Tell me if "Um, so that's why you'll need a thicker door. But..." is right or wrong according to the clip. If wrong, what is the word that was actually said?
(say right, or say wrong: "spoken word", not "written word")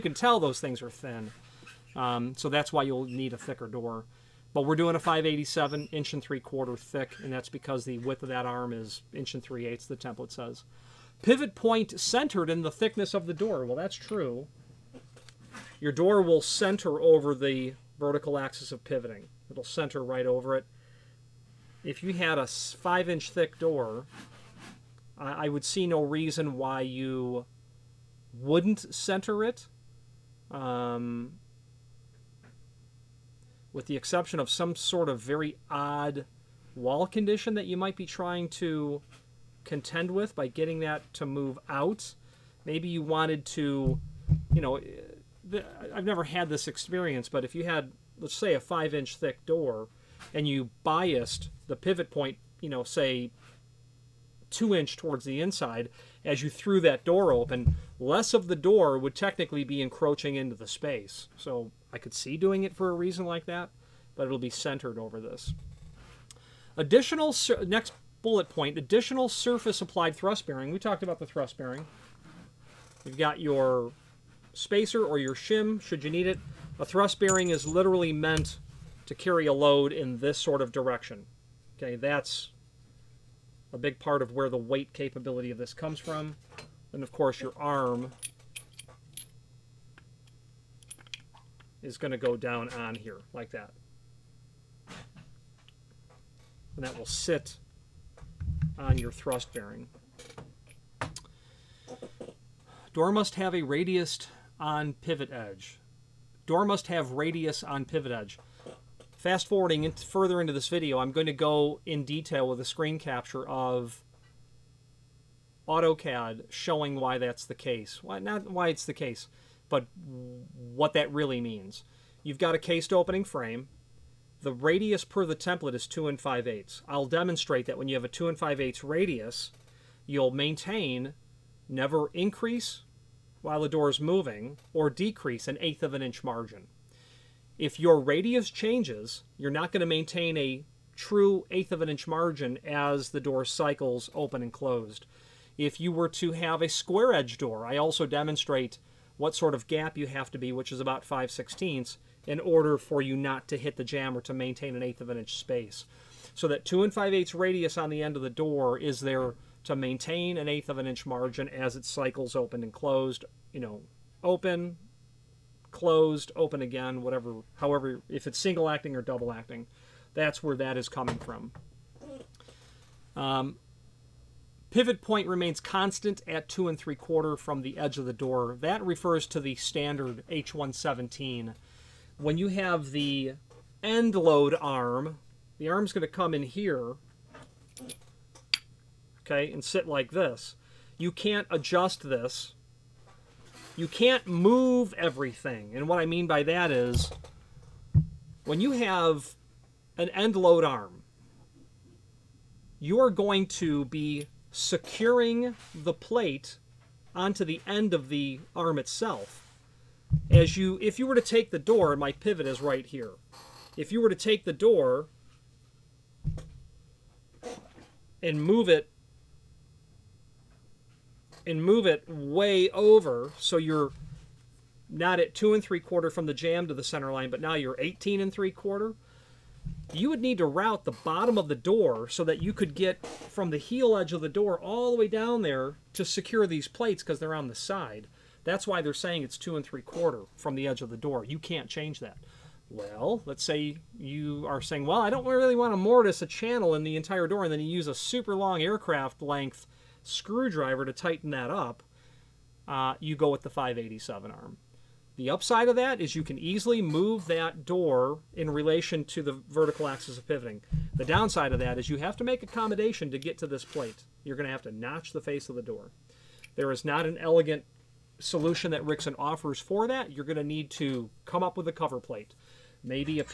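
right.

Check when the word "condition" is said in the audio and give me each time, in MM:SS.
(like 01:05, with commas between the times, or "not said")
00:37.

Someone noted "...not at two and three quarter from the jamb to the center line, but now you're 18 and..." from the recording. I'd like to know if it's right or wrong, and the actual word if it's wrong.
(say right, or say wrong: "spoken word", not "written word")
right.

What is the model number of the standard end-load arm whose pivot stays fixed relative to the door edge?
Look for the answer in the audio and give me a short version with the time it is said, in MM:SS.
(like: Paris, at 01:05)
H117, at 03:00.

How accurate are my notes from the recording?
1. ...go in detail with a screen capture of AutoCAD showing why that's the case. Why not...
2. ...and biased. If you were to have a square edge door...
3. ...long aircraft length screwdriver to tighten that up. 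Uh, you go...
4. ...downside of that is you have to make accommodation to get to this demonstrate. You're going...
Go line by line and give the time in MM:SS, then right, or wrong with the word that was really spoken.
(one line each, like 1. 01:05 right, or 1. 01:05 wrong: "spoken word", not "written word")
1. 01:51 right
2. 02:24 wrong: "closed", not "biased"
3. 04:08 right
4. 04:21 wrong: "plate", not "demonstrate".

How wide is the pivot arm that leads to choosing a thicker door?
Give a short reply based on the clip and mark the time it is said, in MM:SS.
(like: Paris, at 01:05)
1 3/8 inch, at 00:09.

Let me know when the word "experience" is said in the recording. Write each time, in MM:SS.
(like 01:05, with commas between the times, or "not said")
00:46.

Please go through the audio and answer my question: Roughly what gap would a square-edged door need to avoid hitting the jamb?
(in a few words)
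5/16.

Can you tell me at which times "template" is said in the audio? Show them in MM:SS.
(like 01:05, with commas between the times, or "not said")
00:09, 02:05.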